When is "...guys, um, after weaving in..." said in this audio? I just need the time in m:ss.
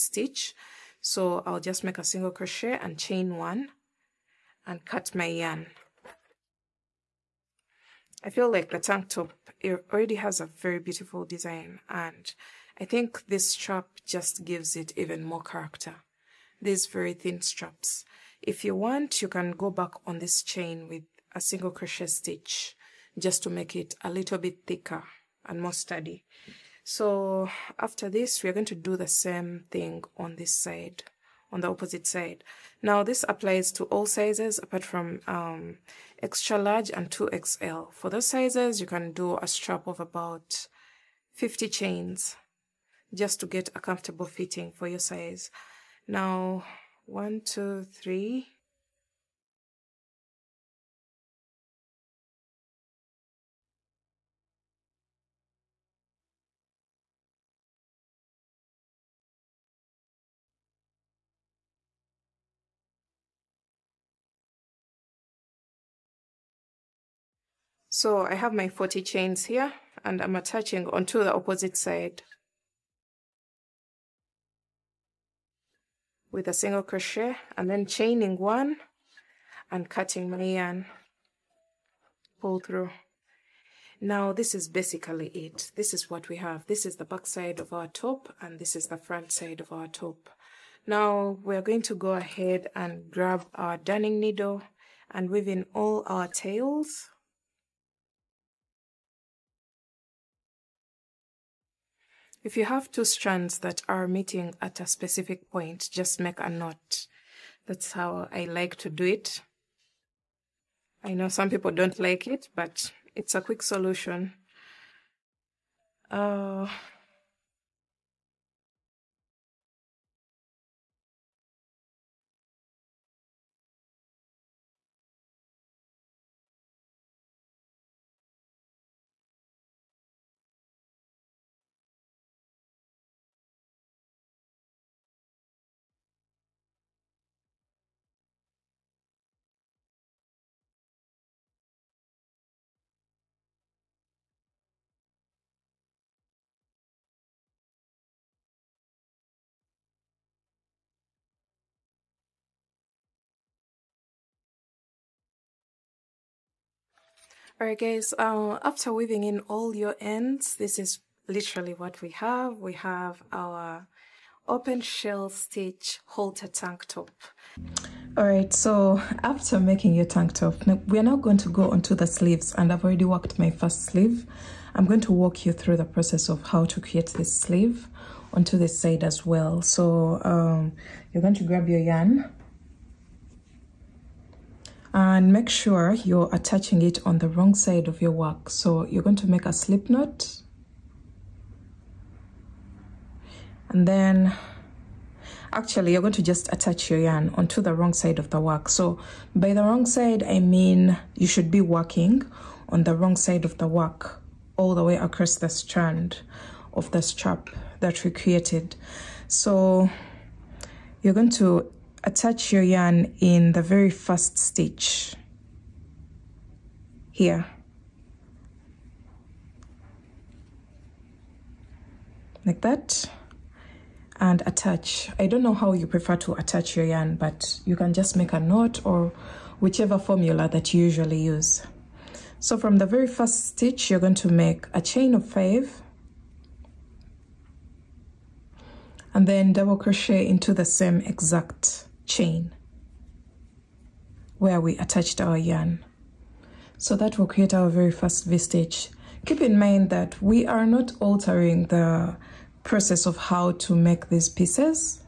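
2:37.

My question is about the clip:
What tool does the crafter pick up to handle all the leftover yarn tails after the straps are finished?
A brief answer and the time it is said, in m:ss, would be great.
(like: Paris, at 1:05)
Darning needle, at 1:33.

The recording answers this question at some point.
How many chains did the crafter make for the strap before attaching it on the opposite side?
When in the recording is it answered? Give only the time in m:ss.
1:08.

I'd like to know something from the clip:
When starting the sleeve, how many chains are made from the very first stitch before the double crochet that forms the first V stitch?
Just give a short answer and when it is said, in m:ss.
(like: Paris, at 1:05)
5, at 3:55.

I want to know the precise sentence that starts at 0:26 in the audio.
So after this, we are going to do the same thing on this side on the opposite side.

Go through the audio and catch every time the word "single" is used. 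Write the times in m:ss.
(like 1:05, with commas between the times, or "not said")
0:02, 0:21, 1:16.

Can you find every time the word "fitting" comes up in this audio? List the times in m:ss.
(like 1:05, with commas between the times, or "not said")
0:44.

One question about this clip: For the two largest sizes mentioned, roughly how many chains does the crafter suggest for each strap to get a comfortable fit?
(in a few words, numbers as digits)
50.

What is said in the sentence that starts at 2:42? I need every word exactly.
We have our open shell stitch halter tank top.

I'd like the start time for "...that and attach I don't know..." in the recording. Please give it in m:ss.
3:42.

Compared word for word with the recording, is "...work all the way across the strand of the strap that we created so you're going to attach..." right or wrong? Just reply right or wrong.
right.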